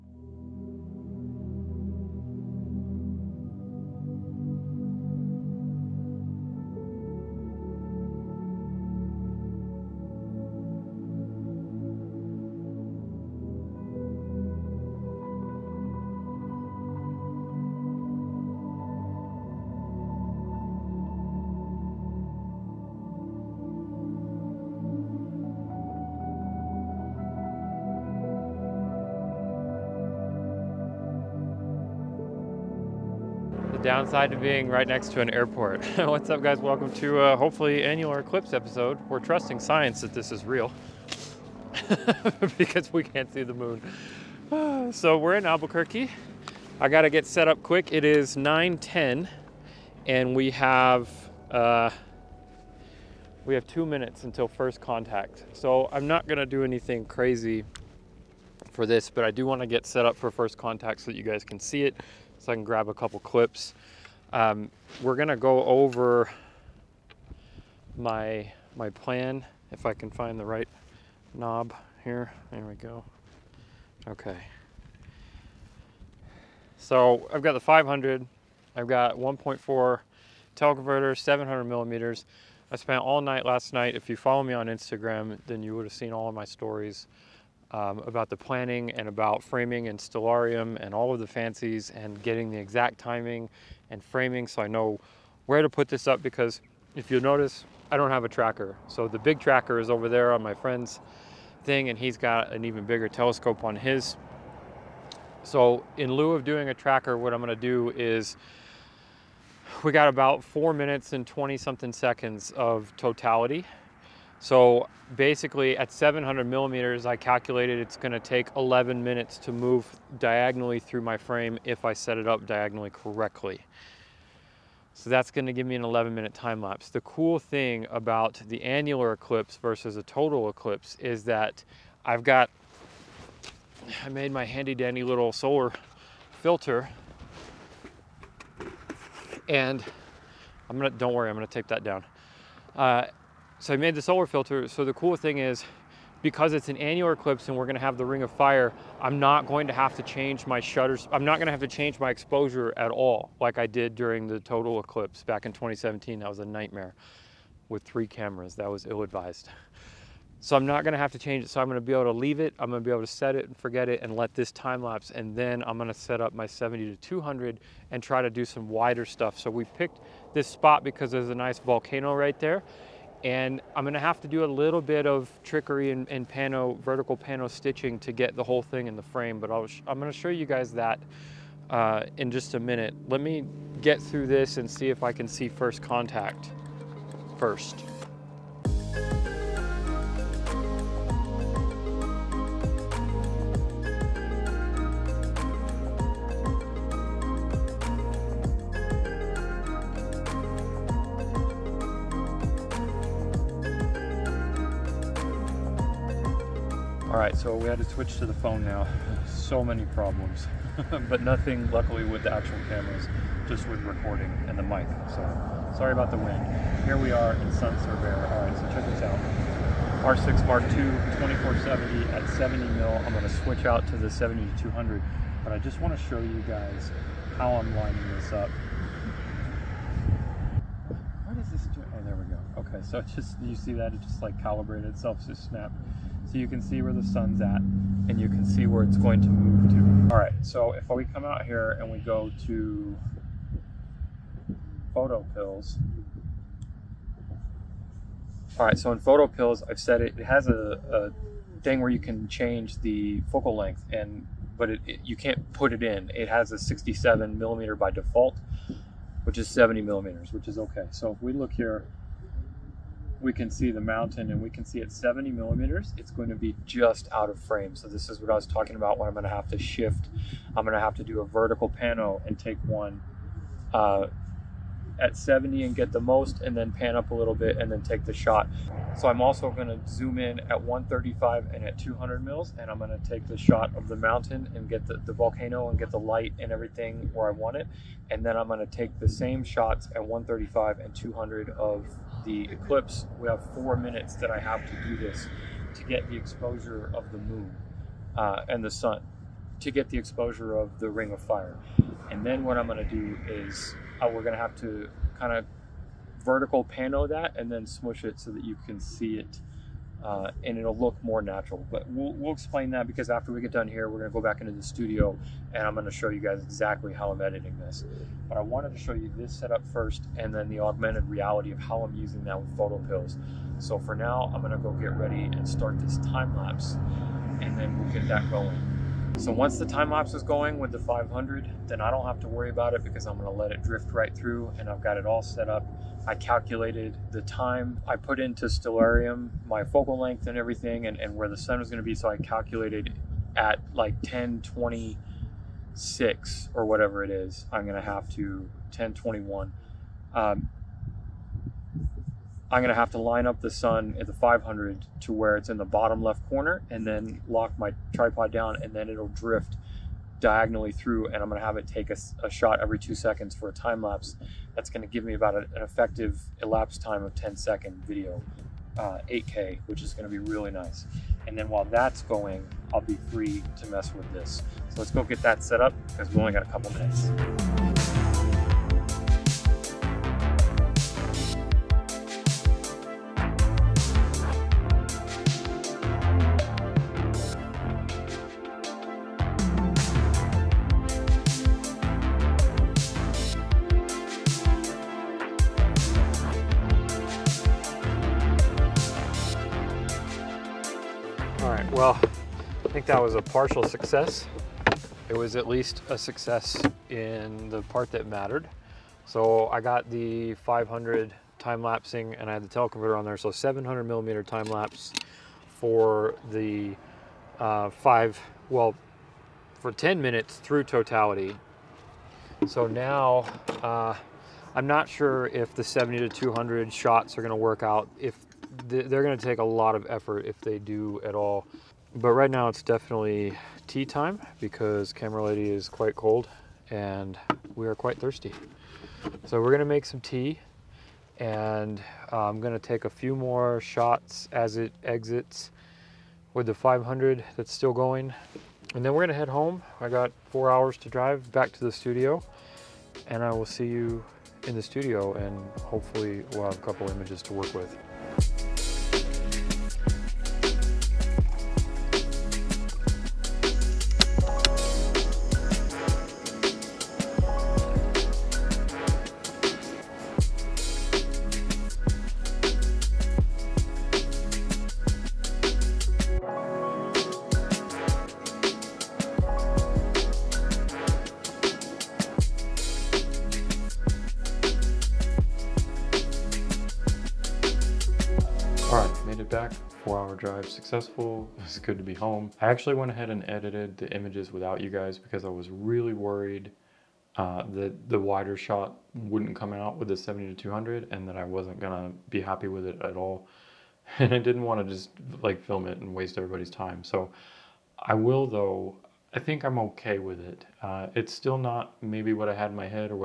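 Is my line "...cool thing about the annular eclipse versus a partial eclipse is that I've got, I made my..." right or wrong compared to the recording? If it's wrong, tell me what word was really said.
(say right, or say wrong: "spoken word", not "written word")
wrong: "total", not "partial".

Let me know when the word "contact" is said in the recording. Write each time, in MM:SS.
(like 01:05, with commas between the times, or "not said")
00:54, 01:00, 03:05.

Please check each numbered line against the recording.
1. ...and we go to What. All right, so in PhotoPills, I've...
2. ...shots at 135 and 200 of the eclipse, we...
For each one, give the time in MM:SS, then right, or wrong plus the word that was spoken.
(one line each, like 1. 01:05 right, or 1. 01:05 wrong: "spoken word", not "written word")
1. 04:01 wrong: "PhotoPills", not "What"
2. 04:49 right.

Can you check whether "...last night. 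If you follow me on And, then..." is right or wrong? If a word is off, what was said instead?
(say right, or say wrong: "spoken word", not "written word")
wrong: "Instagram", not "And".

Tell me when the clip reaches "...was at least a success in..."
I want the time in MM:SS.
06:45.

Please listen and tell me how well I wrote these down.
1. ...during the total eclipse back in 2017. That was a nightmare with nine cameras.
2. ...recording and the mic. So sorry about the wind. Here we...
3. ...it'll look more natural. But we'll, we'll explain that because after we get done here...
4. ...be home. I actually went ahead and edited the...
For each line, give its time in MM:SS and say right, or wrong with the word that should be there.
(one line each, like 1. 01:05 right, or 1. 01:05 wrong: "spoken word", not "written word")
1. 02:33 wrong: "three", not "nine"
2. 03:33 right
3. 05:10 right
4. 08:11 right.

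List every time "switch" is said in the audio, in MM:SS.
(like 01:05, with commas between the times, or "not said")
03:27, 03:43.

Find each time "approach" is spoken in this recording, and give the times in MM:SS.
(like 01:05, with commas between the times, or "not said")
not said.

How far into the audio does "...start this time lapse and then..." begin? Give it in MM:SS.
05:25.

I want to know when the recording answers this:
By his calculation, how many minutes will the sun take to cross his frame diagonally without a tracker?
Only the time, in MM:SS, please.
01:58.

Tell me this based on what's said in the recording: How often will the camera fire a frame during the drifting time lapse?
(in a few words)
every 2 seconds.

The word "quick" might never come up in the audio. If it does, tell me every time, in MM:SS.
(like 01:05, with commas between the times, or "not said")
00:47.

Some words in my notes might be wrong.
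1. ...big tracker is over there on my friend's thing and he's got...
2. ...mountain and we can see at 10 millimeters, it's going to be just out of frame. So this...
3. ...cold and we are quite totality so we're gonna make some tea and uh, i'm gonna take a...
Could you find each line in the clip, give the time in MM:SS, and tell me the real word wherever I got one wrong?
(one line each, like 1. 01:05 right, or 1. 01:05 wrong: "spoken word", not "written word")
1. 01:39 right
2. 04:23 wrong: "70", not "10"
3. 07:15 wrong: "thirsty", not "totality".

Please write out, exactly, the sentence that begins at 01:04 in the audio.
Um, we're gonna go over my, my plan, if I can find the right knob here.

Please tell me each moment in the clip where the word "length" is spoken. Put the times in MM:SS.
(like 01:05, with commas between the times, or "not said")
04:13, 05:39.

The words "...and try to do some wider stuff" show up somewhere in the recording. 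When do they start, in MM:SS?
02:47.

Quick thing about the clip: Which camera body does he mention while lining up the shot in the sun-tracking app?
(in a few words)
R6 Mark II.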